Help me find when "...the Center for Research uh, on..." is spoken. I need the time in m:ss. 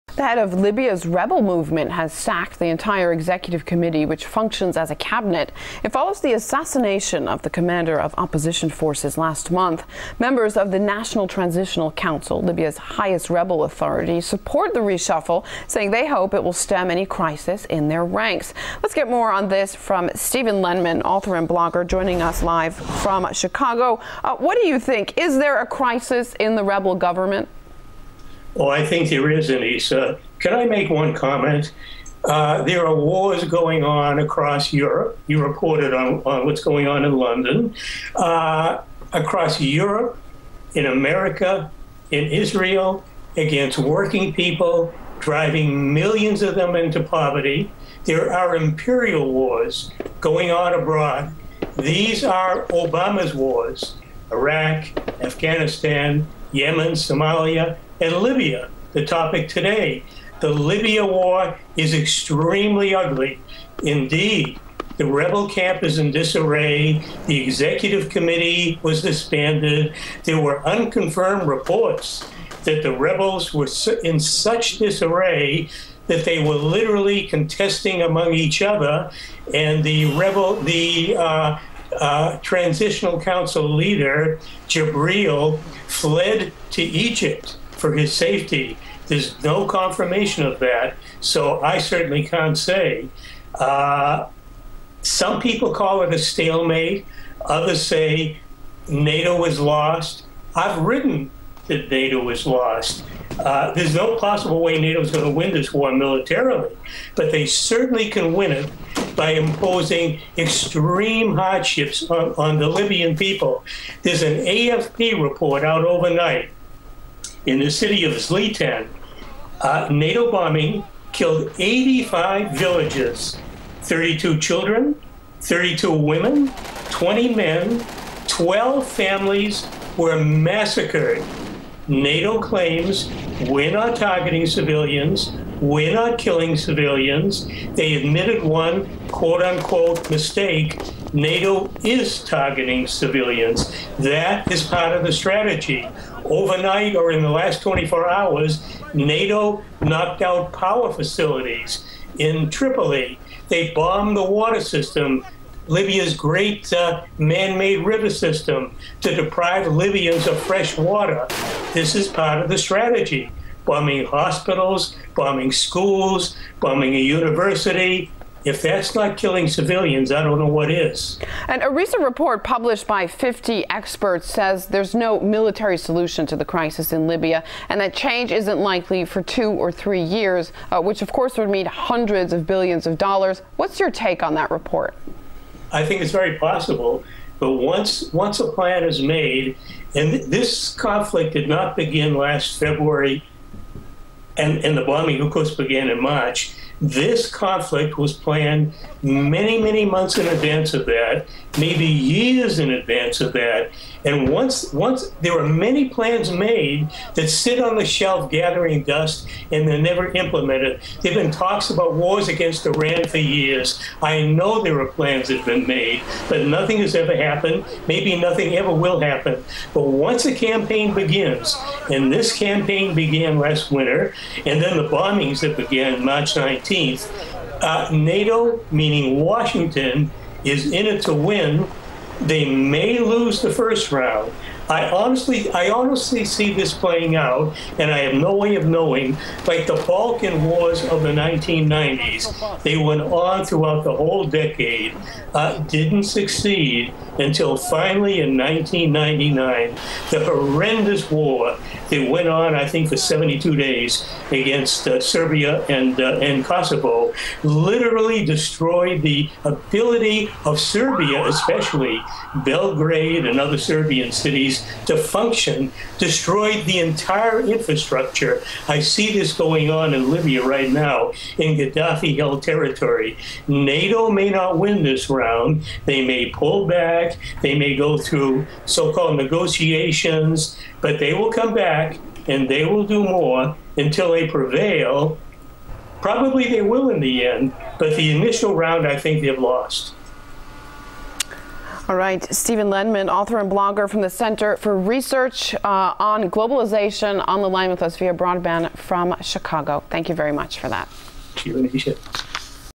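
4:54.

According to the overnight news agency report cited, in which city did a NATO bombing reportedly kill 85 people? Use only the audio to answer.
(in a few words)
Zliten.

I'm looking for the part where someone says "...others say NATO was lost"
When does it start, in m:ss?
1:37.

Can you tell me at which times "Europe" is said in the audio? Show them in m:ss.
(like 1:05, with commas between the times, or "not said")
0:34, 0:39.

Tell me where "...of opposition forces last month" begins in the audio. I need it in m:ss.
0:07.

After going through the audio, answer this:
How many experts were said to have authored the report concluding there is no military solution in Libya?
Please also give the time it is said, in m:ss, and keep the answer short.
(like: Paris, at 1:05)
50, at 2:53.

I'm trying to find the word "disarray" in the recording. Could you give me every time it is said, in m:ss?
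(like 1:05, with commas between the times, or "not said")
1:06, 1:14.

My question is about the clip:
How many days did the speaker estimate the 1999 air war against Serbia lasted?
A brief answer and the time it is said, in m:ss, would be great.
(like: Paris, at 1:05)
72, at 4:12.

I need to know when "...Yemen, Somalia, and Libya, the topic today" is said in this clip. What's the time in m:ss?
0:56.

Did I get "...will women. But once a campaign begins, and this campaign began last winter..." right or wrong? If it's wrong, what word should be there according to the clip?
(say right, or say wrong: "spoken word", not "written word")
wrong: "happen", not "women".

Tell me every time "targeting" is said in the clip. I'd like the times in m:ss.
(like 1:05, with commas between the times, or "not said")
2:13, 2:22.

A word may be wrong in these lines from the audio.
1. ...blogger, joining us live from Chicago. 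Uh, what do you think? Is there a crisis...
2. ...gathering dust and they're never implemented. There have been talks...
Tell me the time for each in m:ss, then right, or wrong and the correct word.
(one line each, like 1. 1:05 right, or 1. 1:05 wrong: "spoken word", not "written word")
1. 0:21 right
2. 3:28 right.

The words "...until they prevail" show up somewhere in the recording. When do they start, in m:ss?
4:43.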